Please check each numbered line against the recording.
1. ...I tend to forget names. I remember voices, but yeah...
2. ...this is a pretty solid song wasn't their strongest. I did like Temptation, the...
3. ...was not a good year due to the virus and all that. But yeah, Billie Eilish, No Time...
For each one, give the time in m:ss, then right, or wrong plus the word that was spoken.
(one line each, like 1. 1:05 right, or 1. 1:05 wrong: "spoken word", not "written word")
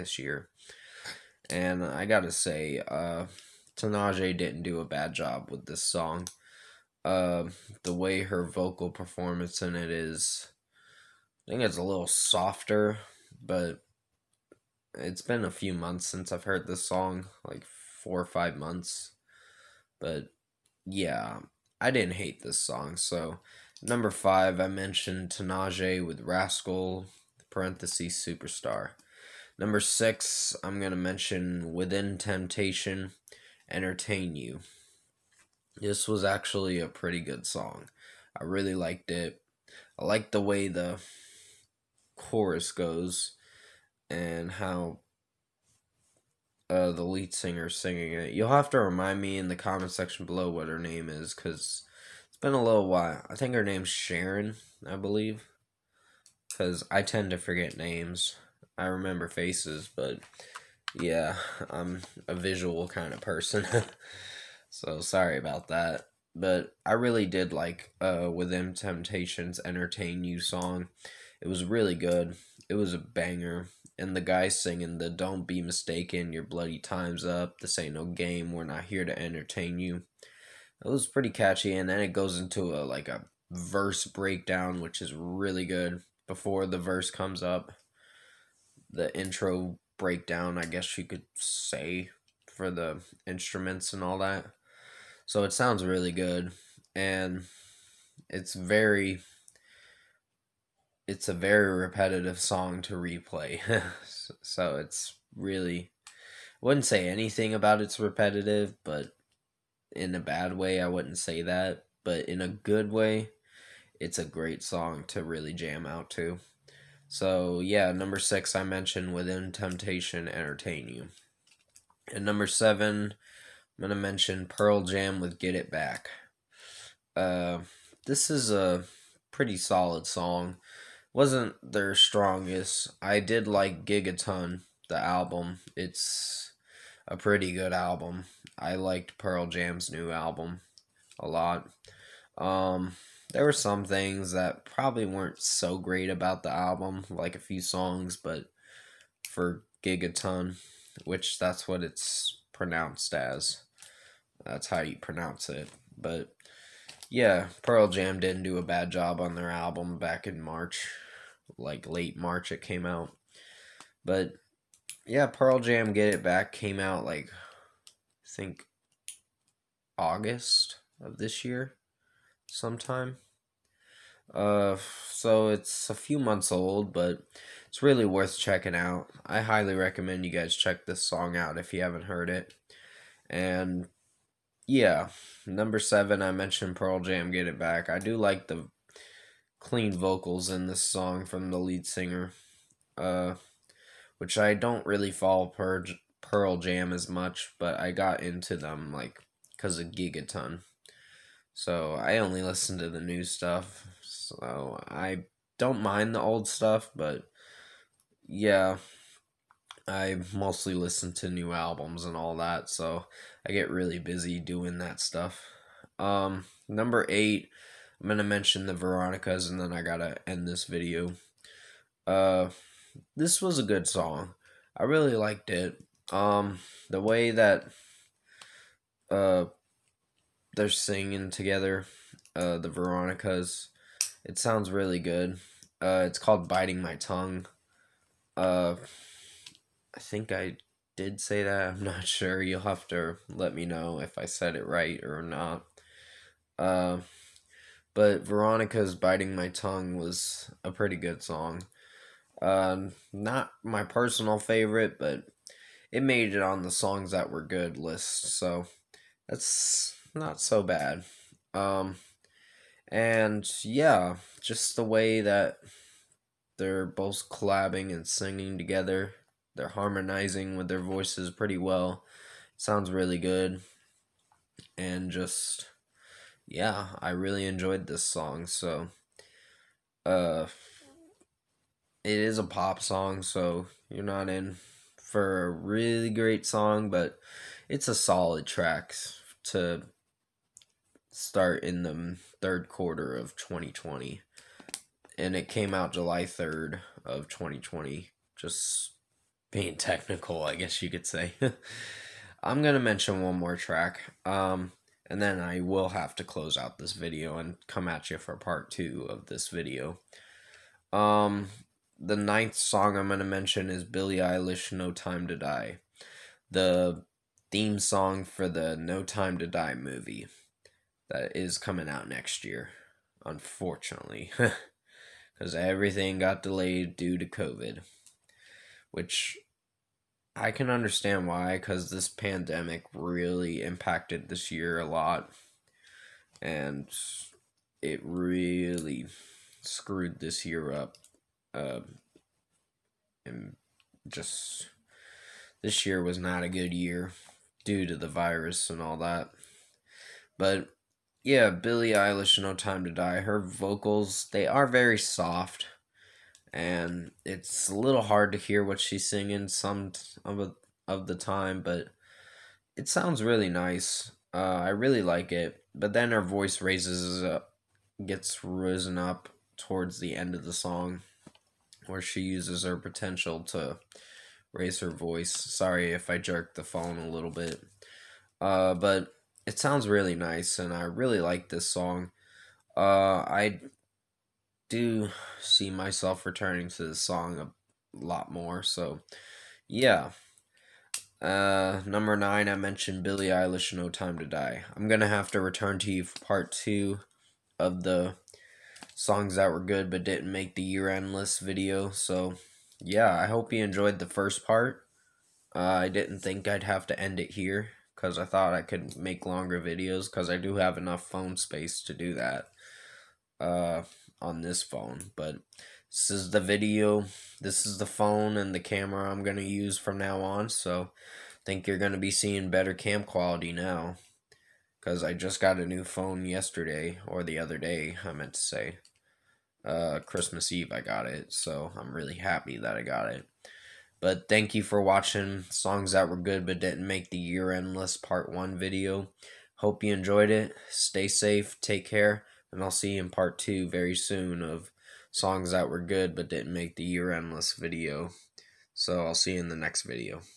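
1. 0:56 wrong: "faces", not "voices"
2. 2:08 wrong: "Gigaton", not "Temptation"
3. 5:46 right.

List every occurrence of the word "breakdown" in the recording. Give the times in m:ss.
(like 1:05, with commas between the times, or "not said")
1:24, 1:29.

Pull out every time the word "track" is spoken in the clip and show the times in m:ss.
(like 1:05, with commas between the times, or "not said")
4:48, 5:03.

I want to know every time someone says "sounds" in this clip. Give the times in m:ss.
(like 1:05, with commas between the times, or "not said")
1:35, 3:54, 4:32, 6:02, 6:19.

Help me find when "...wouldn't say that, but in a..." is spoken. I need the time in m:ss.
1:50.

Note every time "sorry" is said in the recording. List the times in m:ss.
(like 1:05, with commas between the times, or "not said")
1:05, 6:15.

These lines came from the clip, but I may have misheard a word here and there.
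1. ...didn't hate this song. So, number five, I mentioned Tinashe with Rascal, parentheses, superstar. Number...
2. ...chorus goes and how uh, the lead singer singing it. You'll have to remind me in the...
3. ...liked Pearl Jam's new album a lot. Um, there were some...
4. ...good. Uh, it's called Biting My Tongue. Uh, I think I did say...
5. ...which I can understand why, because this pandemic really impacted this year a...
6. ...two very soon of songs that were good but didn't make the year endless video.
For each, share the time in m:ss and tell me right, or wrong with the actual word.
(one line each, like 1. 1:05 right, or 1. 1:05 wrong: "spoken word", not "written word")
1. 0:21 right
2. 0:42 right
3. 2:18 right
4. 3:55 right
5. 5:28 right
6. 7:23 right.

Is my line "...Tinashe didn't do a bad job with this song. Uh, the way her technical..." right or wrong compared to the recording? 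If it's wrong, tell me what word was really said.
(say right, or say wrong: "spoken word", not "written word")
wrong: "vocal", not "technical".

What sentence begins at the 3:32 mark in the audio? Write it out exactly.
So I get really busy doing that stuff.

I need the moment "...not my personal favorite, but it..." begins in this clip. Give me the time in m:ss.
4:13.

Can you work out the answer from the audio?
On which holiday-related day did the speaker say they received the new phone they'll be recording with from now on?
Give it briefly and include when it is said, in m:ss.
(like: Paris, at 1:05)
Christmas Eve, at 7:10.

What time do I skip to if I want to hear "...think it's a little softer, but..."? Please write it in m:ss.
0:11.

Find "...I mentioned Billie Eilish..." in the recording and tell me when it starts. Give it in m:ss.
6:32.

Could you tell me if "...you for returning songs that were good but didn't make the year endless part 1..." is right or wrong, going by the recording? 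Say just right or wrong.
wrong.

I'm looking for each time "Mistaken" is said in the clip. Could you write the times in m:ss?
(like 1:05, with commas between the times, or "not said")
1:15.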